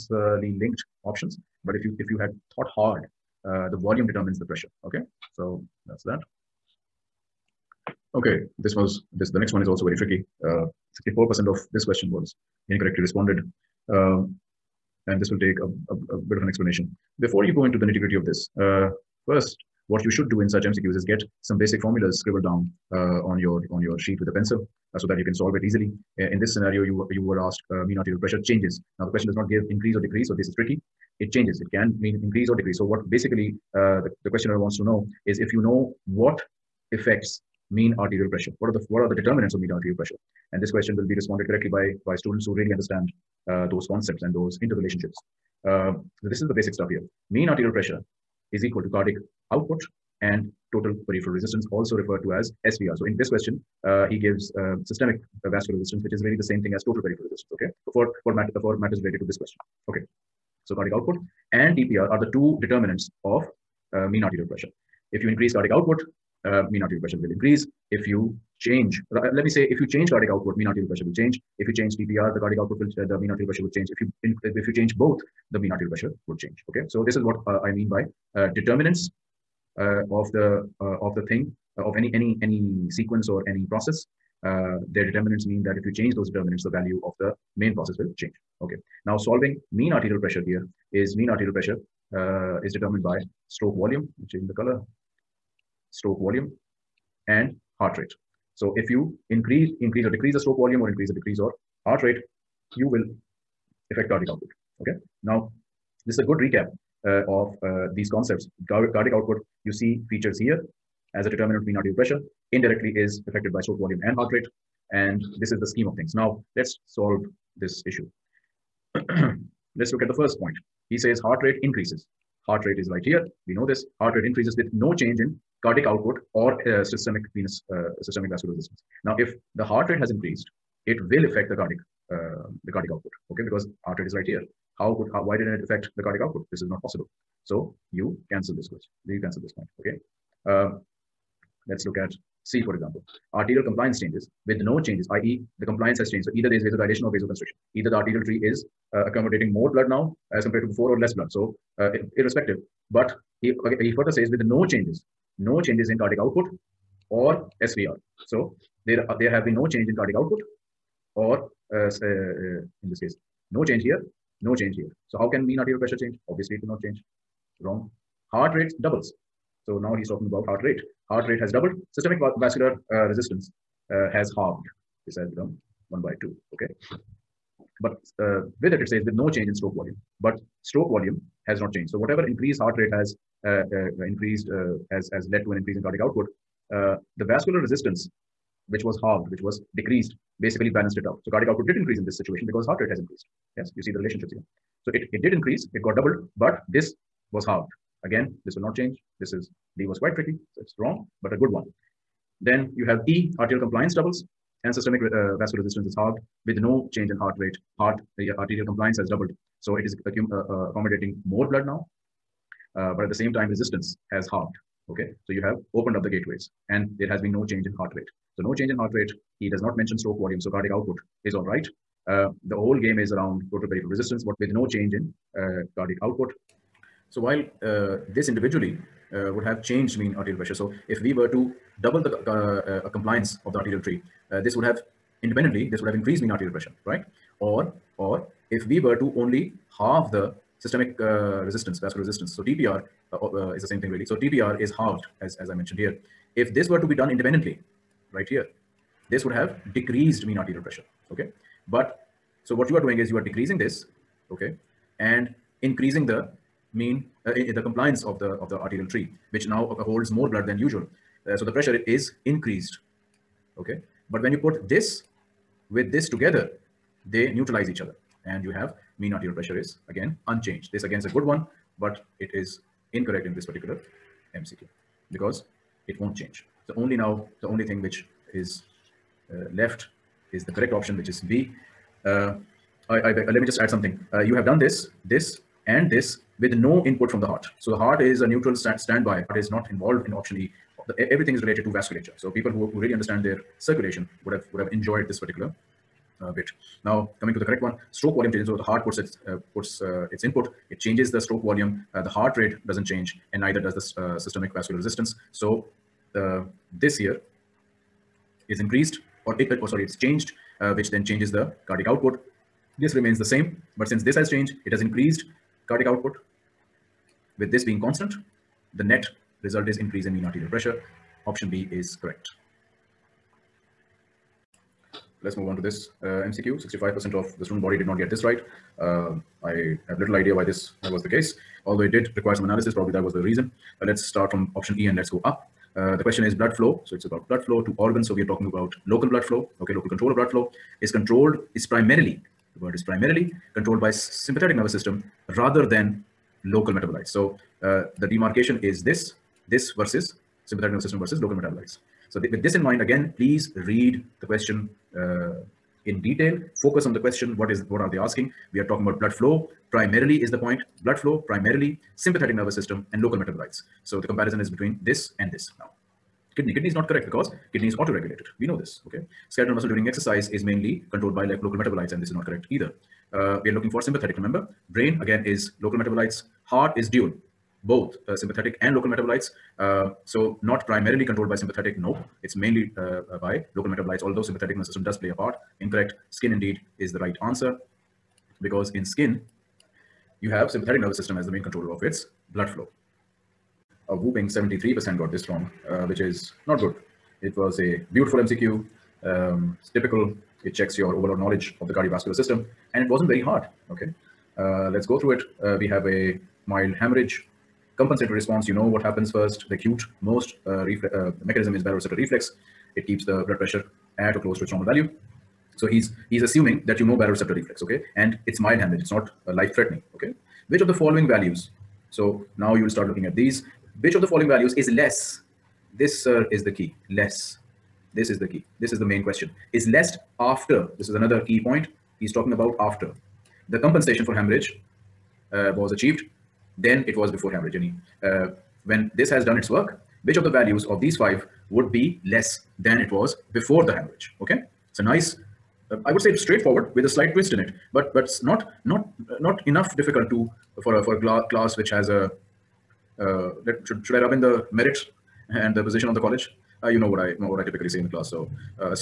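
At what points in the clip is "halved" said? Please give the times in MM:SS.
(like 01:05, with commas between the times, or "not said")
02:54, 03:09, 03:17, 03:25, 03:34, 04:04.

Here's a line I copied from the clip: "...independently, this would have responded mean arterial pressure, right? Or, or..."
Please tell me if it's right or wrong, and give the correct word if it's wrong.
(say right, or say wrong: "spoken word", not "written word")
wrong: "increased", not "responded".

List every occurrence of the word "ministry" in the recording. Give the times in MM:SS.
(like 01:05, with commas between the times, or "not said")
not said.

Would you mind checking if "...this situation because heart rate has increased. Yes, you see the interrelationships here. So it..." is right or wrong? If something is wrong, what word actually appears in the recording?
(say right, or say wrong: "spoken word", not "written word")
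wrong: "relationships", not "interrelationships".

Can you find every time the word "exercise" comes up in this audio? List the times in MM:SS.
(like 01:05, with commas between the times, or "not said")
06:09.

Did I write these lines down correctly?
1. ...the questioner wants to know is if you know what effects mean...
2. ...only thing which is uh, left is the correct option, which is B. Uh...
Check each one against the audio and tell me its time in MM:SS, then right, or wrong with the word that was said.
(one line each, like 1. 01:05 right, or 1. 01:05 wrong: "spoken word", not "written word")
1. 00:34 right
2. 04:37 right.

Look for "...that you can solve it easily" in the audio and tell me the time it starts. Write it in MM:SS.
00:25.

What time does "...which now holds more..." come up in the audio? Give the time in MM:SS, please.
04:19.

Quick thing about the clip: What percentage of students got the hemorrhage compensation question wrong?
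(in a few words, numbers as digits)
73%.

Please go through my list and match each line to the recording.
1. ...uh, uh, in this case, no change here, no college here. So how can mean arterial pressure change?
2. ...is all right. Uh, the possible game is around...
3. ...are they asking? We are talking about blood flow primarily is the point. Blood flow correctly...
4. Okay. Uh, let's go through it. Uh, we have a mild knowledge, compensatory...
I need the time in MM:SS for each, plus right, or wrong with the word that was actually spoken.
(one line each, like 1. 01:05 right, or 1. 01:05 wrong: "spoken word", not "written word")
1. 02:41 wrong: "change", not "college"
2. 03:41 wrong: "whole", not "possible"
3. 05:57 wrong: "primarily", not "correctly"
4. 06:43 wrong: "hemorrhage", not "knowledge".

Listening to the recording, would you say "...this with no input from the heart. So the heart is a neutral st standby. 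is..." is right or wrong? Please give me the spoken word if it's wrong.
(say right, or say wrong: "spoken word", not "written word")
right.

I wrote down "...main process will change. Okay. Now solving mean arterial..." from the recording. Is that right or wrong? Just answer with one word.
right.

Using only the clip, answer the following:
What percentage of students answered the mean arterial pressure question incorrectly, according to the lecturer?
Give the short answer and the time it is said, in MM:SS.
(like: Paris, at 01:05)
64%, at 00:10.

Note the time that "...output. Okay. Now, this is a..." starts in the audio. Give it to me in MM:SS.
01:44.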